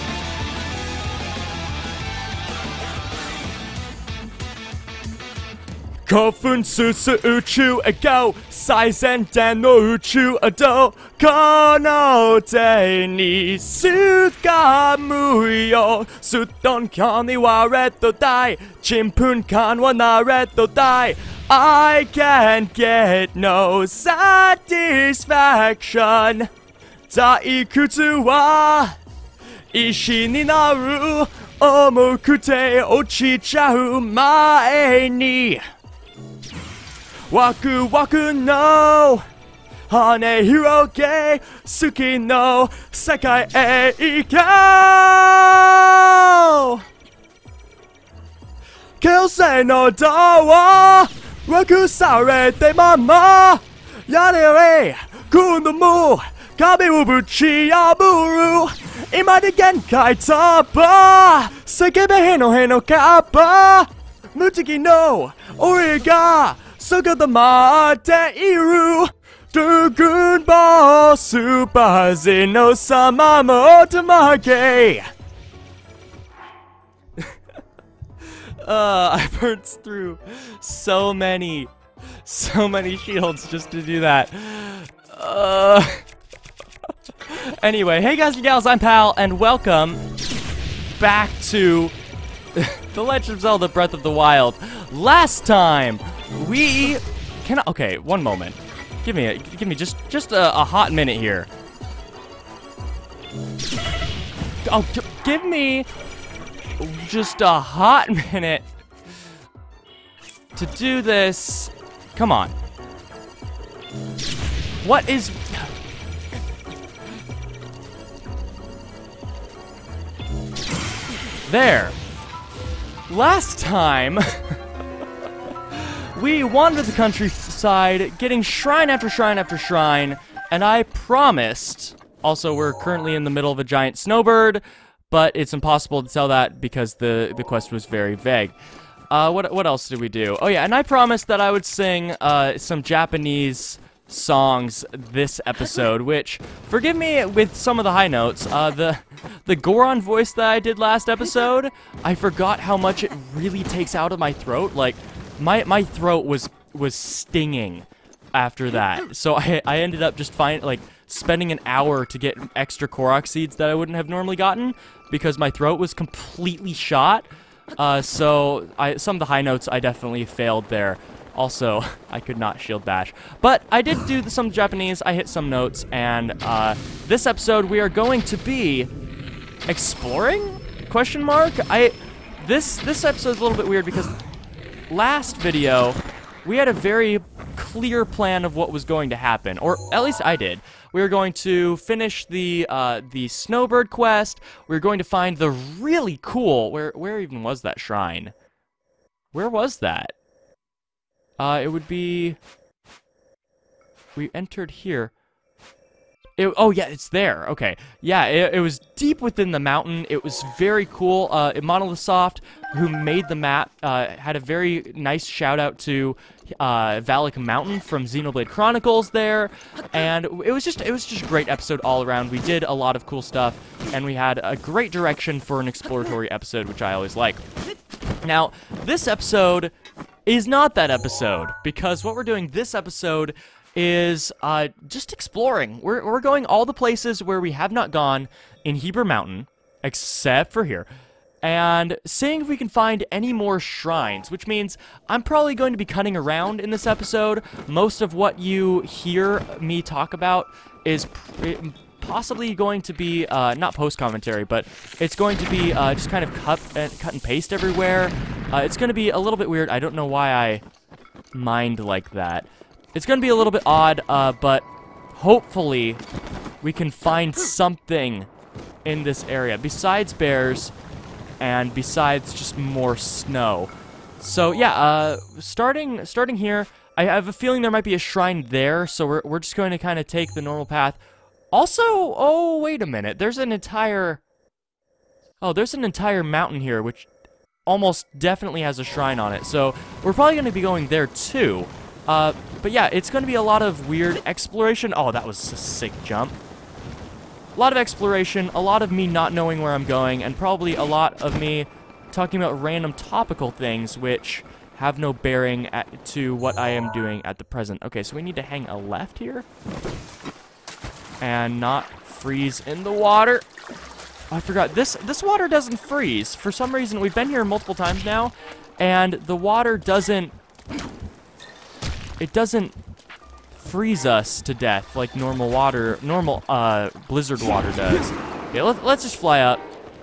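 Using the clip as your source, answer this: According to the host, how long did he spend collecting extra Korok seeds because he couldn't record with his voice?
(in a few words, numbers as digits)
an hour.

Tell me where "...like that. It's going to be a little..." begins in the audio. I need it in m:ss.
4:21.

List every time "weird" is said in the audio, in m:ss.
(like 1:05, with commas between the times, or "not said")
3:03, 4:19, 4:53.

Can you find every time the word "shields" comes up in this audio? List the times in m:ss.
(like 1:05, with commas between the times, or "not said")
1:22, 2:52.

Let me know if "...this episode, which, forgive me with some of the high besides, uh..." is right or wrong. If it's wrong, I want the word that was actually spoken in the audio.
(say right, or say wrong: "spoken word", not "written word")
wrong: "notes", not "besides".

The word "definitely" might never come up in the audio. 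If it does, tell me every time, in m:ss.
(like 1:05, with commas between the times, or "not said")
2:49, 4:48.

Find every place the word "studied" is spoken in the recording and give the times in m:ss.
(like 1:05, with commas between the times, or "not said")
not said.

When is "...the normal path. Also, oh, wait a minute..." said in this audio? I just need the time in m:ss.
4:40.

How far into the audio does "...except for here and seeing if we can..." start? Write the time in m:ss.
3:59.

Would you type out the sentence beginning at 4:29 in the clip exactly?
Besides bears, and besides just more snow.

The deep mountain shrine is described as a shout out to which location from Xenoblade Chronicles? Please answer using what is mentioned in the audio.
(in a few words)
Valak Mountain.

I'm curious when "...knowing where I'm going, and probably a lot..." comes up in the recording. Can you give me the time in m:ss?
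4:59.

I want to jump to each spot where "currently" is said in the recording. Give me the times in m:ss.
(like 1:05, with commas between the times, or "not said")
2:12.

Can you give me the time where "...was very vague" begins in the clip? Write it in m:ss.
2:17.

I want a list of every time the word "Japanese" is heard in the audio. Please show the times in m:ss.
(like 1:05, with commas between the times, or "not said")
2:22, 2:54.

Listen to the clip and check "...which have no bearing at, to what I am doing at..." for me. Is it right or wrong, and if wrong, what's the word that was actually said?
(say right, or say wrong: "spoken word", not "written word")
right.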